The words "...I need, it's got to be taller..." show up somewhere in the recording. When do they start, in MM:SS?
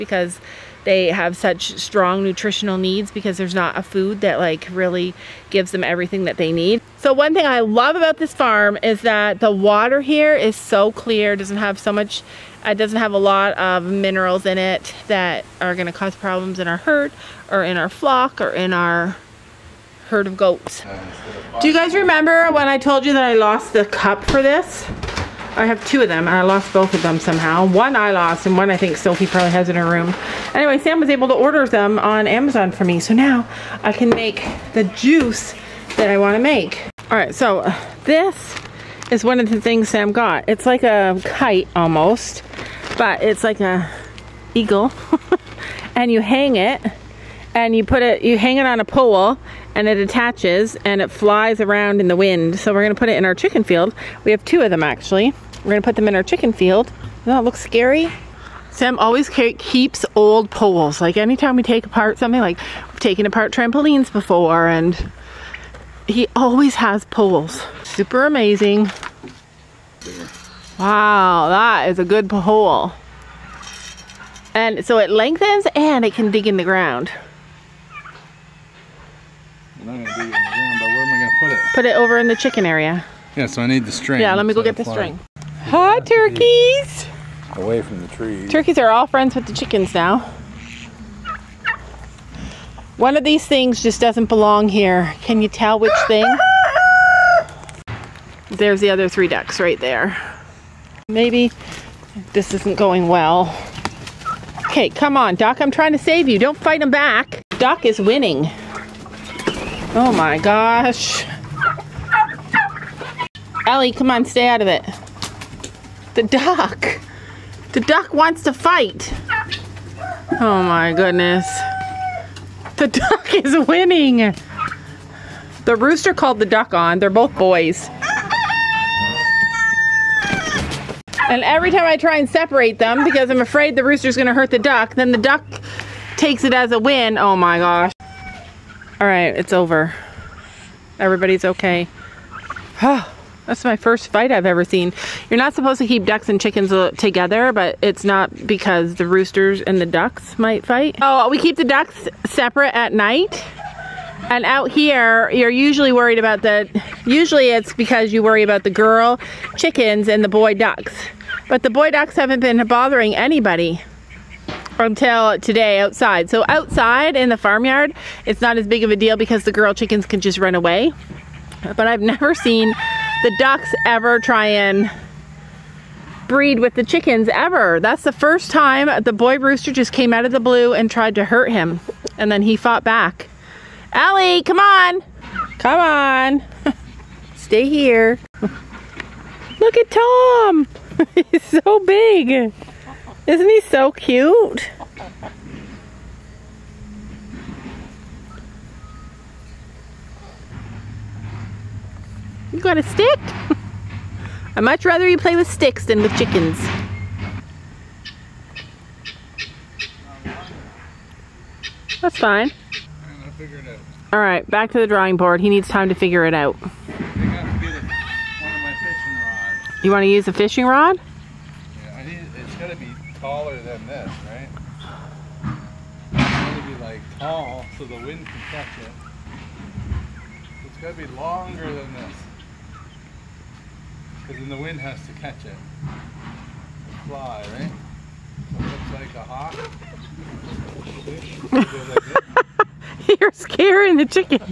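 03:41.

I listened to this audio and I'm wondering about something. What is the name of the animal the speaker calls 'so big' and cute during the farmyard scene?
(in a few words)
Tom.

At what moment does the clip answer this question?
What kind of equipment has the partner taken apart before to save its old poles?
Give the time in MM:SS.
01:03.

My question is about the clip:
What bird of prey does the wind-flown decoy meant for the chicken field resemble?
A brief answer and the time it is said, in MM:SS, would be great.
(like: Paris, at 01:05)
Eagle, at 00:44.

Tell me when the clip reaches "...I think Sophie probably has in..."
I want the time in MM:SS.
00:28.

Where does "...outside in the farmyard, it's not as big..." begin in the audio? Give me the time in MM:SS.
02:46.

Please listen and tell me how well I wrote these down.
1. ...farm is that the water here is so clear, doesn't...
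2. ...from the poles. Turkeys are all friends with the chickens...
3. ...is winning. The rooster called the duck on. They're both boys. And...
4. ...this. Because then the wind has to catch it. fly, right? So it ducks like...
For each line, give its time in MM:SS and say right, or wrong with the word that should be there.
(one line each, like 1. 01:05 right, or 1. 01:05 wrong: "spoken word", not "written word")
1. 00:08 right
2. 01:27 wrong: "trees", not "poles"
3. 02:03 right
4. 03:51 wrong: "looks", not "ducks".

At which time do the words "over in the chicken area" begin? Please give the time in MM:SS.
01:21.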